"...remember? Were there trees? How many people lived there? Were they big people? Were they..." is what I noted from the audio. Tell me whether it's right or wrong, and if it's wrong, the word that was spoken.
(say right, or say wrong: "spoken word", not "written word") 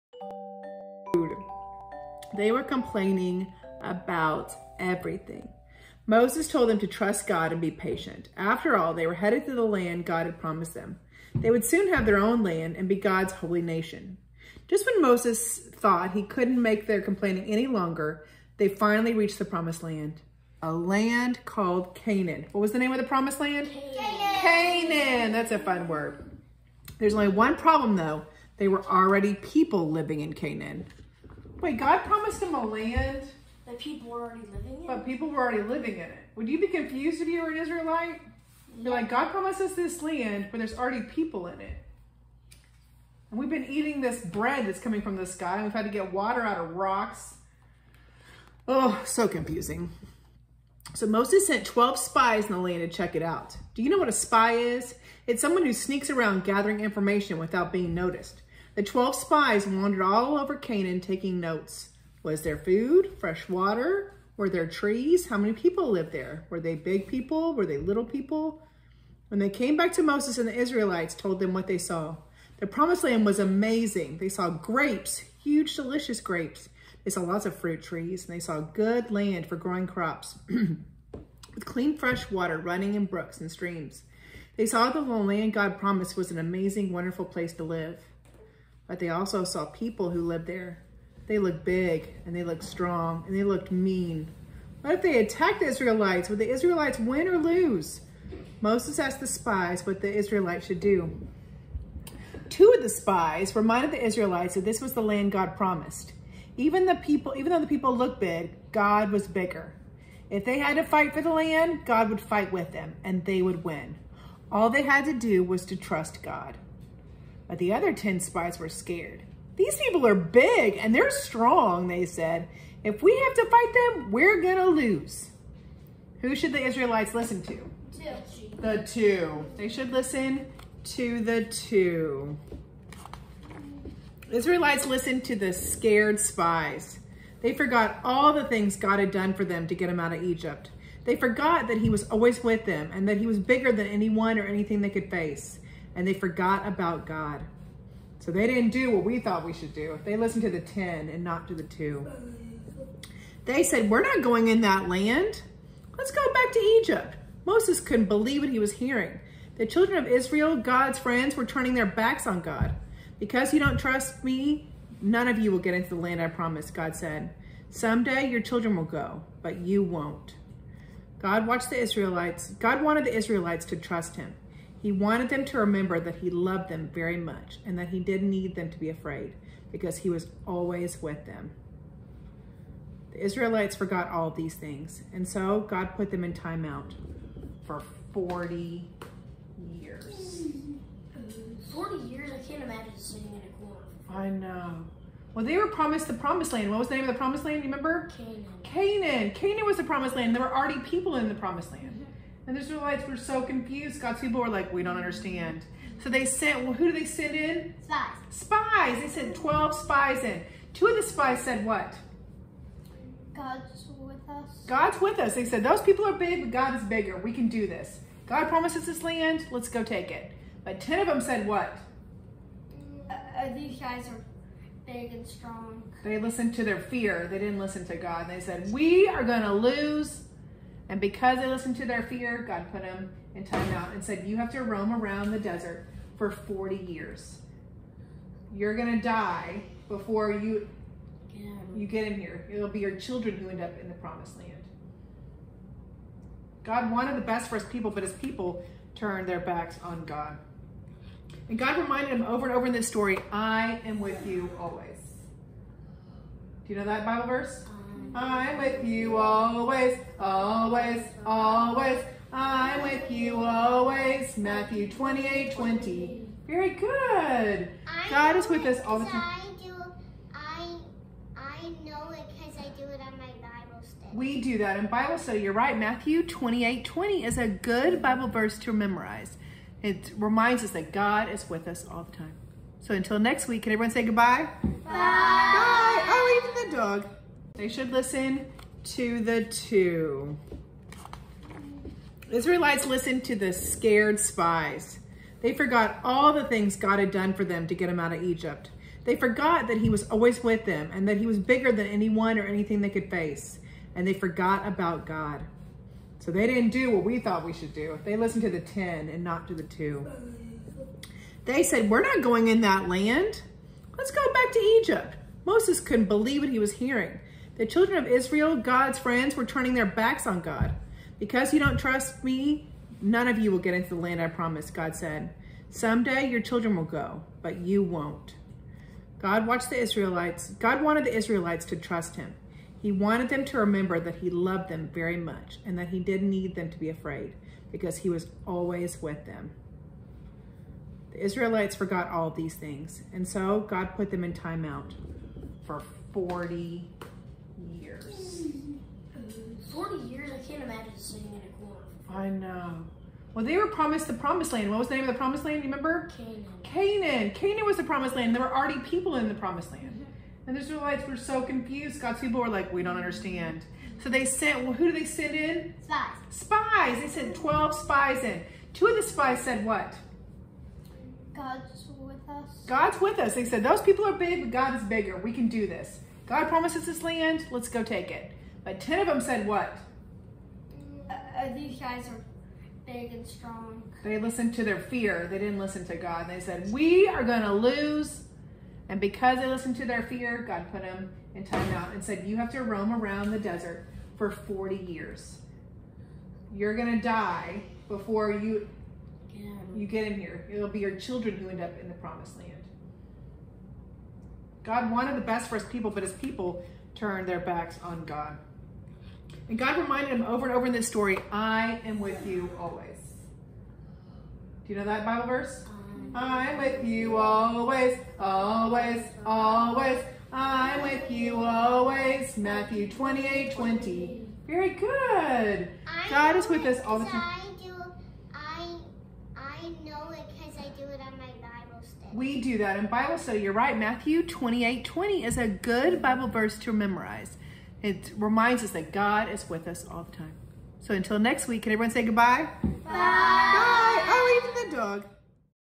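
wrong: "water", not "remember".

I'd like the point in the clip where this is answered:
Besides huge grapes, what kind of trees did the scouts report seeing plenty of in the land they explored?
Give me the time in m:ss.
1:17.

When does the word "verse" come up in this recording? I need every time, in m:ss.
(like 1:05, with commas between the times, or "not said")
4:17, 4:38, 6:55, 7:16.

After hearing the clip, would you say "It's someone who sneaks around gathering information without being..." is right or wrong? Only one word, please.
right.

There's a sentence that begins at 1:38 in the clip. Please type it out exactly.
Moses asked the spies what the Israelites should do.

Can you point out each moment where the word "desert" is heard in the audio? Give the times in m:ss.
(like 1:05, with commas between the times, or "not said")
3:55, 6:33.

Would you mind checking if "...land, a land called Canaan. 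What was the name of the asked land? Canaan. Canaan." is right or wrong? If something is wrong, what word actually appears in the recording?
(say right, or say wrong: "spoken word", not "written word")
wrong: "promised", not "asked".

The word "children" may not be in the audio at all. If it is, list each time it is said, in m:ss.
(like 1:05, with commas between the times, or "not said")
2:39, 2:48, 4:02, 5:17, 5:26, 6:40.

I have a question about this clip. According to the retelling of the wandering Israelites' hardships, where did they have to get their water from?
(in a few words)
rocks.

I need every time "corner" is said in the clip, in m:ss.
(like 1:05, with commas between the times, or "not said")
3:13, 5:51.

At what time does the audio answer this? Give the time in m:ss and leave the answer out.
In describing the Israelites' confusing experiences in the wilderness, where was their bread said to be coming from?
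0:45.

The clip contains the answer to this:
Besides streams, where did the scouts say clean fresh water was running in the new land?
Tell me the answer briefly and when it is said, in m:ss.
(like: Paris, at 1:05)
brooks, at 1:23.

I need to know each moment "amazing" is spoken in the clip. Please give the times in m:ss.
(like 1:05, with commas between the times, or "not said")
1:13, 1:26.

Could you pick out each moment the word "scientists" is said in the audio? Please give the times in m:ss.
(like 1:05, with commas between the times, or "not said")
not said.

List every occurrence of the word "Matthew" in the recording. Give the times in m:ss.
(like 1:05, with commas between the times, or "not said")
4:24, 4:35, 7:02, 7:13.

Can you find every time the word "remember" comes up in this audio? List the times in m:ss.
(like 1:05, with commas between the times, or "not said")
2:55, 3:17, 5:33, 5:55.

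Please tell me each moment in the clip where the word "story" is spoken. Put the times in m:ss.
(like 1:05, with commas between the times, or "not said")
4:12, 6:50.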